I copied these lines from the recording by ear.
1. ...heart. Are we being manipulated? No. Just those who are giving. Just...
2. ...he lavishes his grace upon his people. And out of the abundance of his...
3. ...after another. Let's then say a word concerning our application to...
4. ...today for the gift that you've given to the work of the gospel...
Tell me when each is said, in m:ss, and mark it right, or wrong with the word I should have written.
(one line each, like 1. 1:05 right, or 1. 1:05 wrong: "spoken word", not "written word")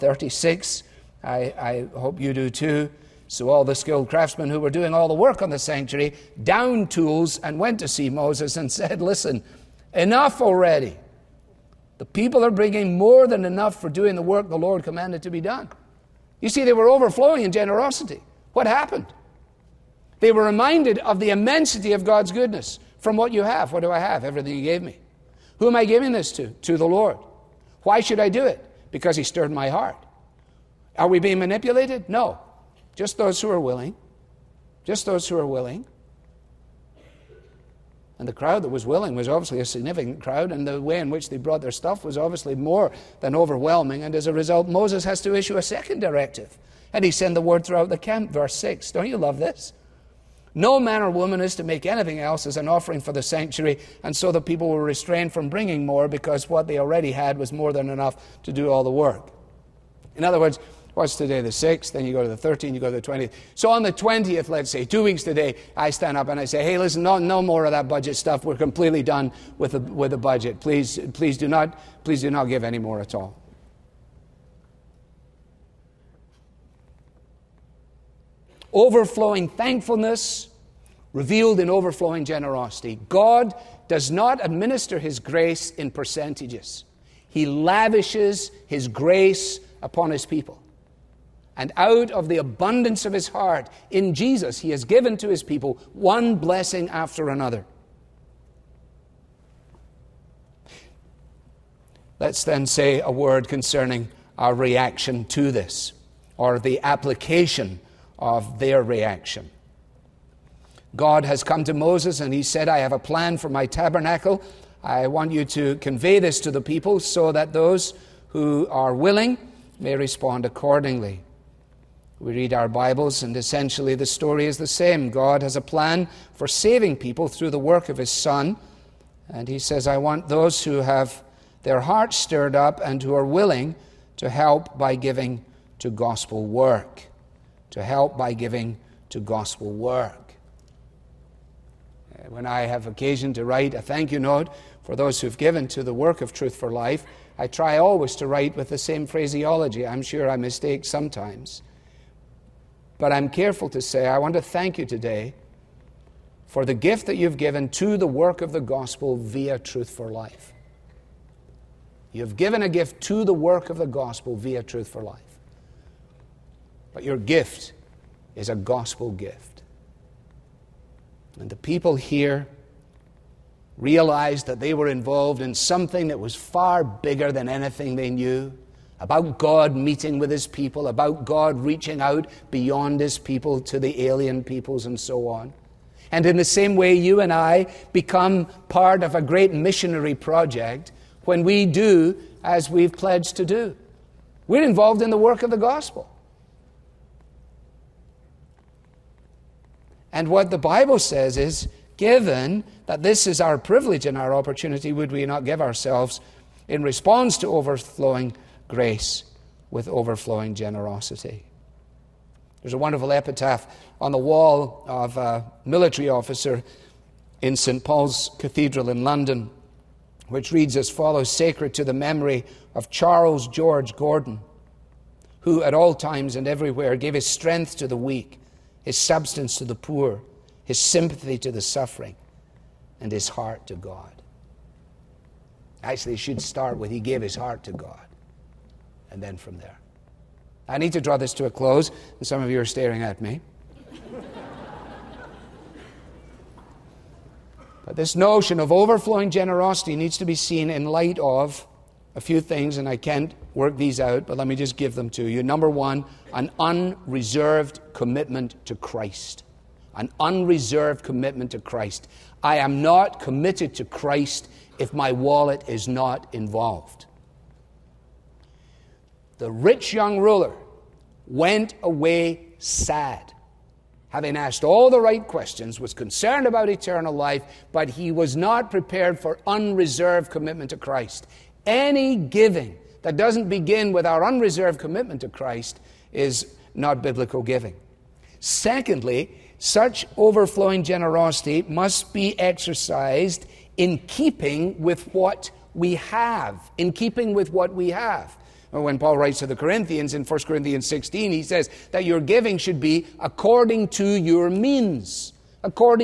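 1. 0:29 wrong: "willing", not "giving"
2. 1:27 right
3. 1:36 wrong: "reaction", not "application"
4. 2:34 right.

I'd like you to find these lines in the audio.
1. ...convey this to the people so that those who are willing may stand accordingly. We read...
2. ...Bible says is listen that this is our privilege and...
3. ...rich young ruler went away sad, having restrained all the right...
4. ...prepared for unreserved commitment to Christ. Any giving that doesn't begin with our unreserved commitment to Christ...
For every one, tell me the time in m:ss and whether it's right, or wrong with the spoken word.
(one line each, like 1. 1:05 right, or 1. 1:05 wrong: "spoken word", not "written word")
1. 1:55 wrong: "respond", not "stand"
2. 3:20 wrong: "given", not "listen"
3. 4:29 wrong: "asked", not "restrained"
4. 4:38 right.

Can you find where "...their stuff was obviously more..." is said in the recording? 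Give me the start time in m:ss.
0:41.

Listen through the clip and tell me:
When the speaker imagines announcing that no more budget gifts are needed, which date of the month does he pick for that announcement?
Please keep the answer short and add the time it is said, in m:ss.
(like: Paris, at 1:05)
20th, at 1:03.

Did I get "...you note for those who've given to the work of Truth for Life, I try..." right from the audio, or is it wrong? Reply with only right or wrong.
right.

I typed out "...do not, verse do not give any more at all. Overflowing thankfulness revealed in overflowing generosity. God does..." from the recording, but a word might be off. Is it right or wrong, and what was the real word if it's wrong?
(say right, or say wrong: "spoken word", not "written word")
wrong: "please", not "verse".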